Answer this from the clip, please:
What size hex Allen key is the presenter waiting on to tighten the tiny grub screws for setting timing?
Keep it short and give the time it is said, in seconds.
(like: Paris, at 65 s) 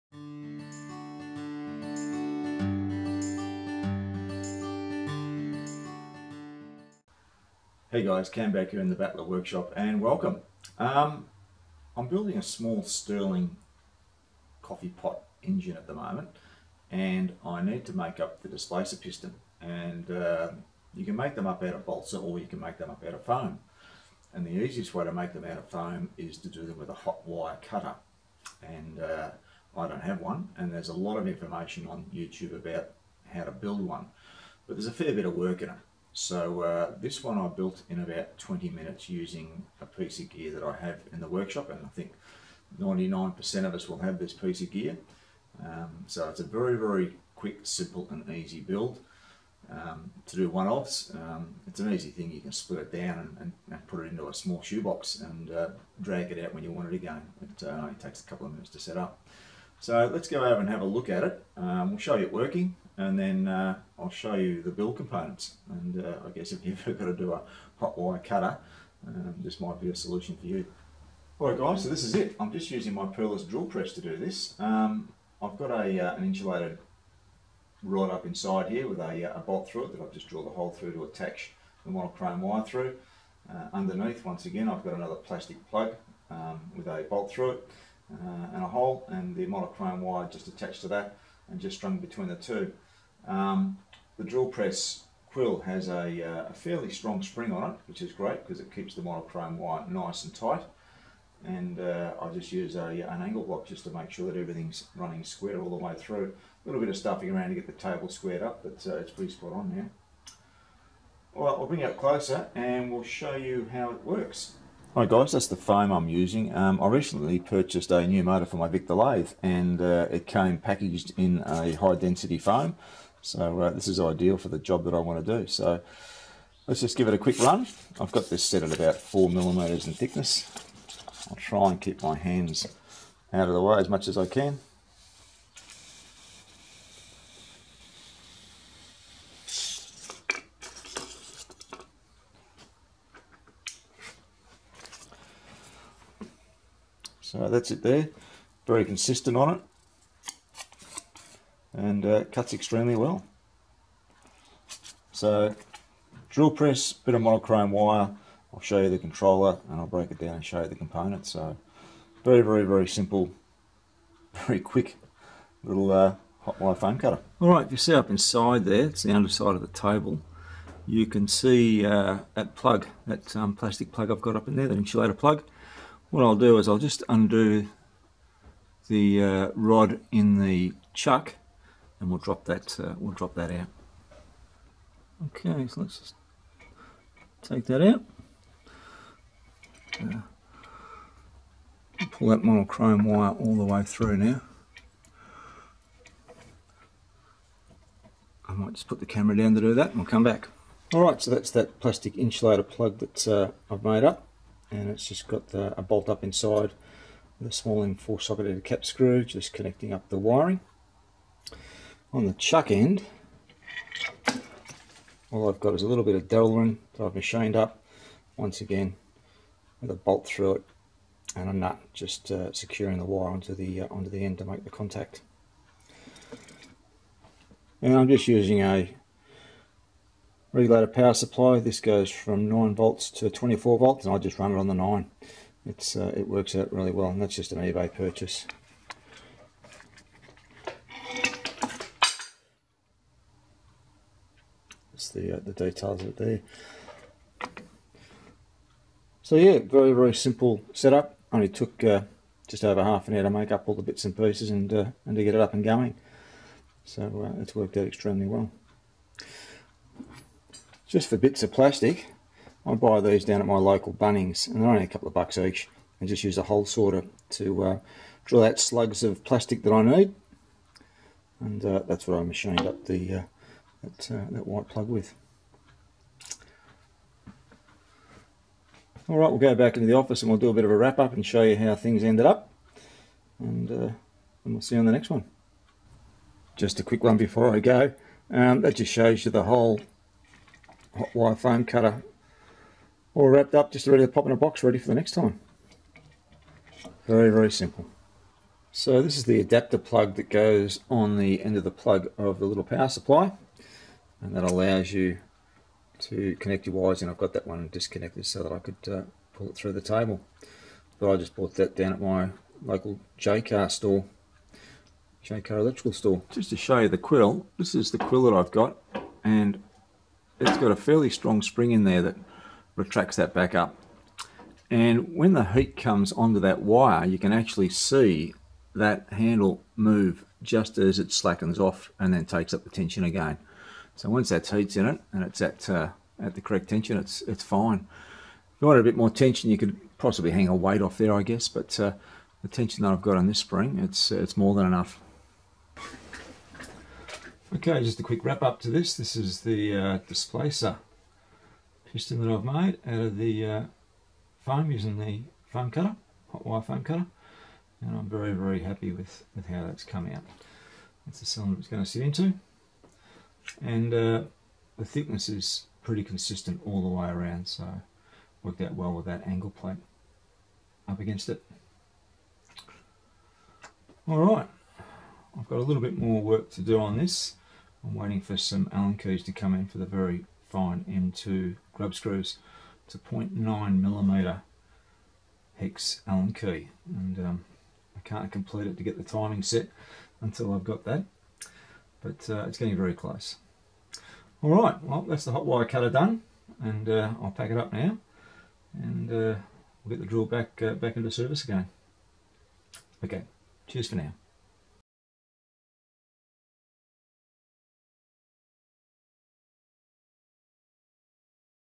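0.9 millimeter, at 382 s.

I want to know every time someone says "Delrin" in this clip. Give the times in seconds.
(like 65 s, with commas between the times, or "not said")
216 s.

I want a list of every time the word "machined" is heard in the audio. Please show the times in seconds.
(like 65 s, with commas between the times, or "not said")
217 s, 272 s.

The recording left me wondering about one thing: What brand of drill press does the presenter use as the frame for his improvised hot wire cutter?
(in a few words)
Perlis.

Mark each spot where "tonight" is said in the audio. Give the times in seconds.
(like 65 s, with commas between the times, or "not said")
not said.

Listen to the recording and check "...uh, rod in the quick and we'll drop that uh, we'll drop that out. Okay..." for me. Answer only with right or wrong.
wrong.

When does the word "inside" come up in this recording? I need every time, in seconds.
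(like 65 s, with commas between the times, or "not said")
78 s, 168 s, 206 s.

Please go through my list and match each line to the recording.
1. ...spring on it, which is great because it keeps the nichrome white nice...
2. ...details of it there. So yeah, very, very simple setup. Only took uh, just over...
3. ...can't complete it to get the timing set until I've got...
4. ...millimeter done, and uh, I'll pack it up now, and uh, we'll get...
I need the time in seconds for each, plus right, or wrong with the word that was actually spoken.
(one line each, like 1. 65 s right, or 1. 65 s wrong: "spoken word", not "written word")
1. 97 s right
2. 245 s right
3. 388 s right
4. 395 s wrong: "cutter", not "millimeter".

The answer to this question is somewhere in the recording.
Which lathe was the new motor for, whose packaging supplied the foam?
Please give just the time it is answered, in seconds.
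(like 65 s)
118 s.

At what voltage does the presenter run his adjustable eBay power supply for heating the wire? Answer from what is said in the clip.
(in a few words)
9 volts.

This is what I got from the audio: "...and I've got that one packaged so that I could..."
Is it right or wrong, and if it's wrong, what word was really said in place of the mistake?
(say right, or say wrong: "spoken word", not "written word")
wrong: "disconnected", not "packaged".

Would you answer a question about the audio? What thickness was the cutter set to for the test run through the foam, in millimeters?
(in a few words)
4.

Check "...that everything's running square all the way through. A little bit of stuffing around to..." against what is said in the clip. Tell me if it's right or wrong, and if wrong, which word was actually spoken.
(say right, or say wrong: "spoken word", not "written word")
right.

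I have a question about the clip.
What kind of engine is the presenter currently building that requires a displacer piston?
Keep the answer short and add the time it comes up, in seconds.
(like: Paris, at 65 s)
Stirling coffee pot engine, at 12 s.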